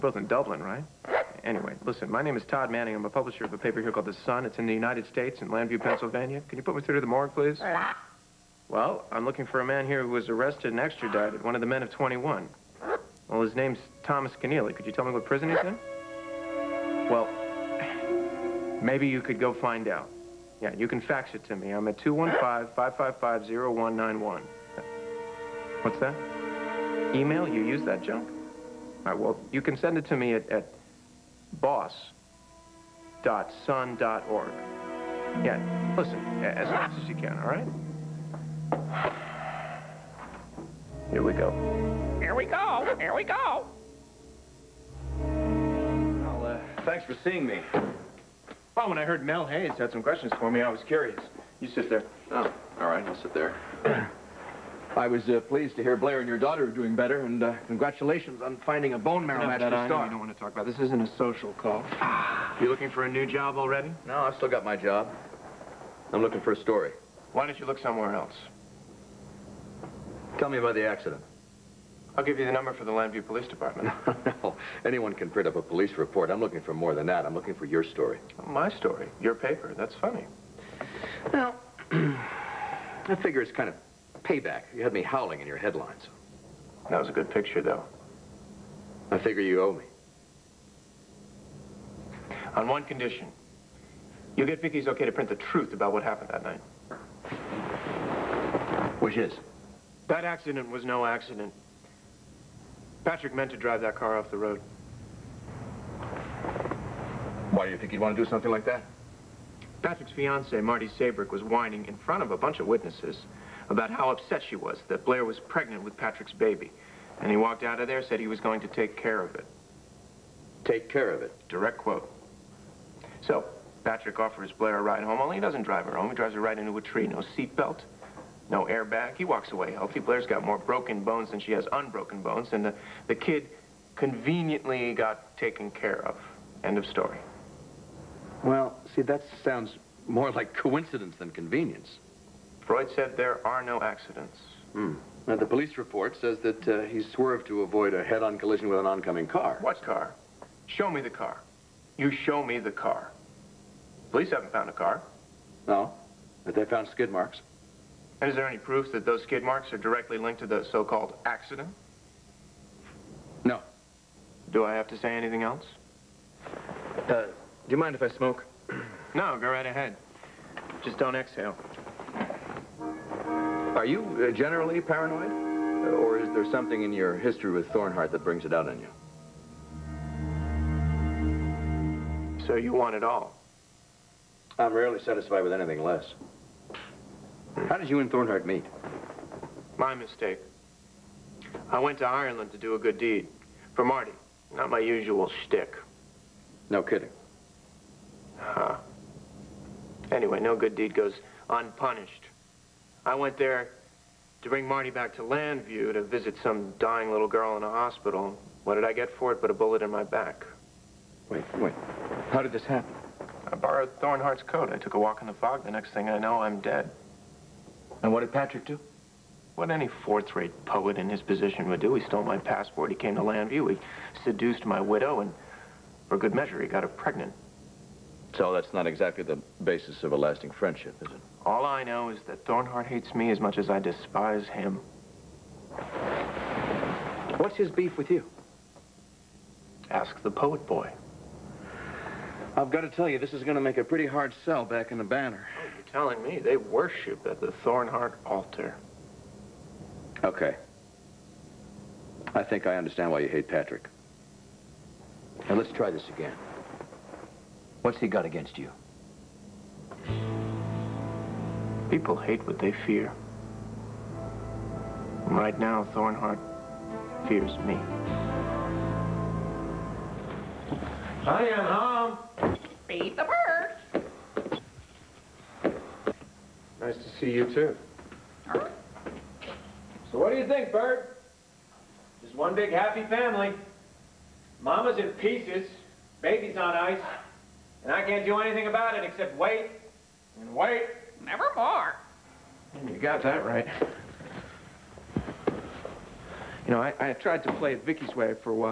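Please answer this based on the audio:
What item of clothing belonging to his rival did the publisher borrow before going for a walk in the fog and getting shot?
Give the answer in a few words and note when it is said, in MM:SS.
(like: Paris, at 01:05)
Thornhart's coat, at 03:34.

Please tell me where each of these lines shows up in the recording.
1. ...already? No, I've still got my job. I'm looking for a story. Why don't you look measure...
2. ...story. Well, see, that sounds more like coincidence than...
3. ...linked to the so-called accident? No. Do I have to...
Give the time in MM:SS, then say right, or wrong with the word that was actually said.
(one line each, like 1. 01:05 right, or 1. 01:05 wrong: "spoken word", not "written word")
1. 01:03 wrong: "somewhere", not "measure"
2. 02:16 right
3. 02:40 right.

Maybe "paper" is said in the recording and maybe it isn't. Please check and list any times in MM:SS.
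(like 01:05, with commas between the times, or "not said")
00:03, 01:19.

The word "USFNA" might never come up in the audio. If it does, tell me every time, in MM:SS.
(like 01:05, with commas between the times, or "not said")
not said.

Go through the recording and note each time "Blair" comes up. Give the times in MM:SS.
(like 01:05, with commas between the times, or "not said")
00:55, 01:55, 02:04, 02:10.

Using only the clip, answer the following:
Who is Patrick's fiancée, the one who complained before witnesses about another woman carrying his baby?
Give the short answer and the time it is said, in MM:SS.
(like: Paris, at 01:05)
Marty Saybrooke, at 01:50.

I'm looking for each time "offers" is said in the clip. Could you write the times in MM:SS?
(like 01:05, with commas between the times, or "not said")
02:04.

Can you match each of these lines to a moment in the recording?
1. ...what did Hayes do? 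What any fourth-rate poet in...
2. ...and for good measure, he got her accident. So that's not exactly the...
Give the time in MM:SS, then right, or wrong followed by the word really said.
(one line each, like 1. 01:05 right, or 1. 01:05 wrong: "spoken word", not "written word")
1. 03:38 wrong: "Patrick", not "Hayes"
2. 03:45 wrong: "pregnant", not "accident".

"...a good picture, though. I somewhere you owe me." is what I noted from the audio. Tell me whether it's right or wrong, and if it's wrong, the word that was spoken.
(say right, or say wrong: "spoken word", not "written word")
wrong: "figure", not "somewhere".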